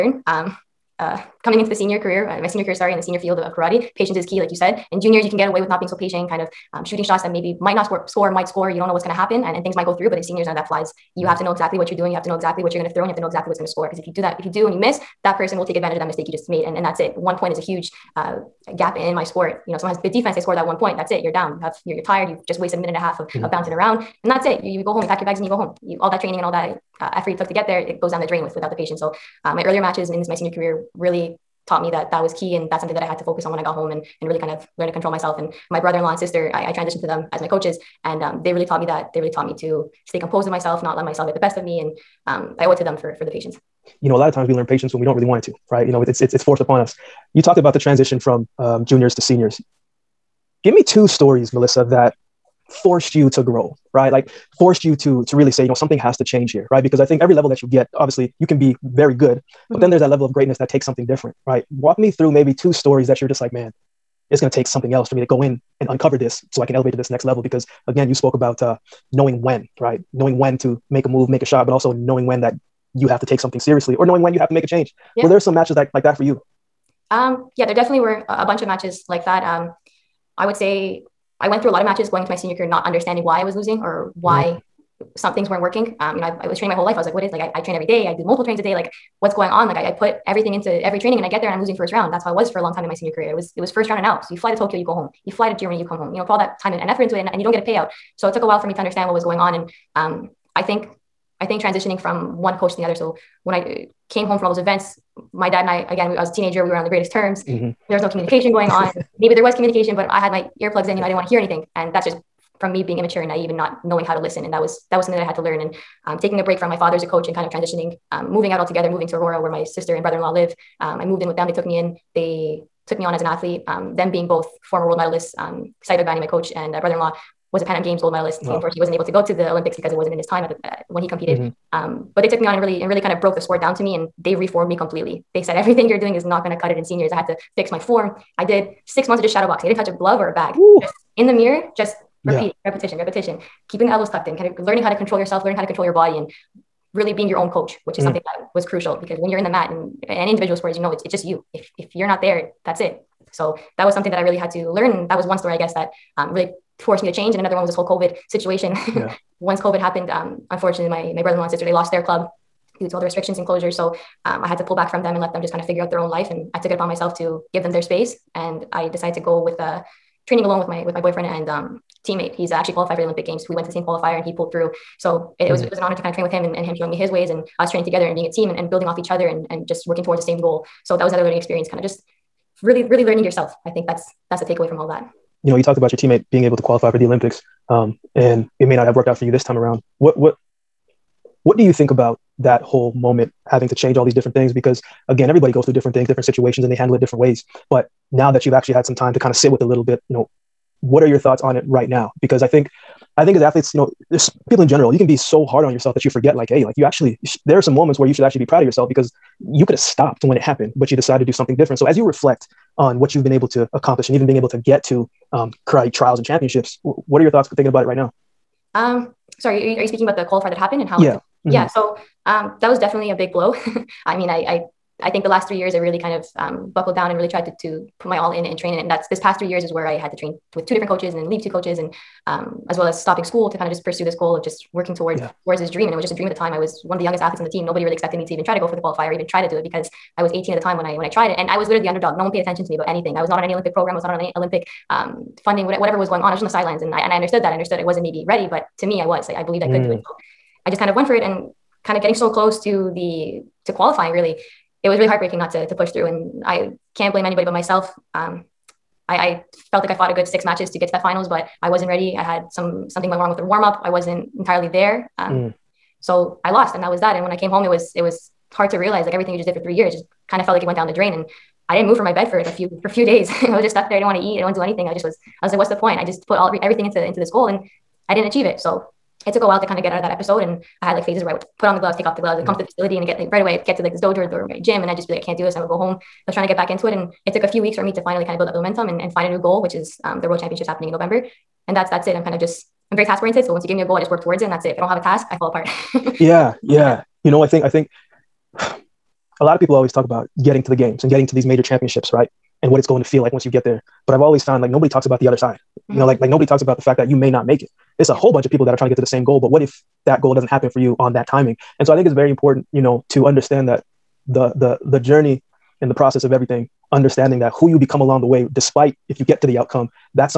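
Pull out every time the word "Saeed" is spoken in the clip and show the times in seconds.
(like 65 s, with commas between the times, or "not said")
125 s.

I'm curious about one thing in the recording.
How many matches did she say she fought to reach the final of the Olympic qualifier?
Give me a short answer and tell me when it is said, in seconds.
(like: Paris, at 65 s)
6, at 260 s.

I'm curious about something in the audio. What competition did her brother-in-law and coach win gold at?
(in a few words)
Pan Am Games.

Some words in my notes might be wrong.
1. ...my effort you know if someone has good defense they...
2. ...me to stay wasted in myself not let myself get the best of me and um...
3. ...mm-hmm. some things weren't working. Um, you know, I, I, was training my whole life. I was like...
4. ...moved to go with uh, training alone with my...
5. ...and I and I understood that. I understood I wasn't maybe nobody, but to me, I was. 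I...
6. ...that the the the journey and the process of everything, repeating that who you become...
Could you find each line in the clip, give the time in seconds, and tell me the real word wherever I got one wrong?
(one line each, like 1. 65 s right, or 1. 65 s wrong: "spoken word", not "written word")
1. 19 s wrong: "sport", not "effort"
2. 39 s wrong: "composed", not "wasted"
3. 85 s right
4. 168 s wrong: "decided", not "moved"
5. 246 s wrong: "ready", not "nobody"
6. 313 s wrong: "understanding", not "repeating".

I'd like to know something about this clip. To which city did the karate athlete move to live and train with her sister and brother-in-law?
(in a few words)
Aurora.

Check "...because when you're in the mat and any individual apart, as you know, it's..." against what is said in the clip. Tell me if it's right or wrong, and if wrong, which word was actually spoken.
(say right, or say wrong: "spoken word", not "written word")
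wrong: "sport", not "apart".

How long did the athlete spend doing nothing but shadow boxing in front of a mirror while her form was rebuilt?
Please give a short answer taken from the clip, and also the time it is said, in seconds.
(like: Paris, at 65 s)
6 months, at 138 s.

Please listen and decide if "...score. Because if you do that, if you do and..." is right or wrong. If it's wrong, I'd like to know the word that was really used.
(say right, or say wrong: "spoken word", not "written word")
right.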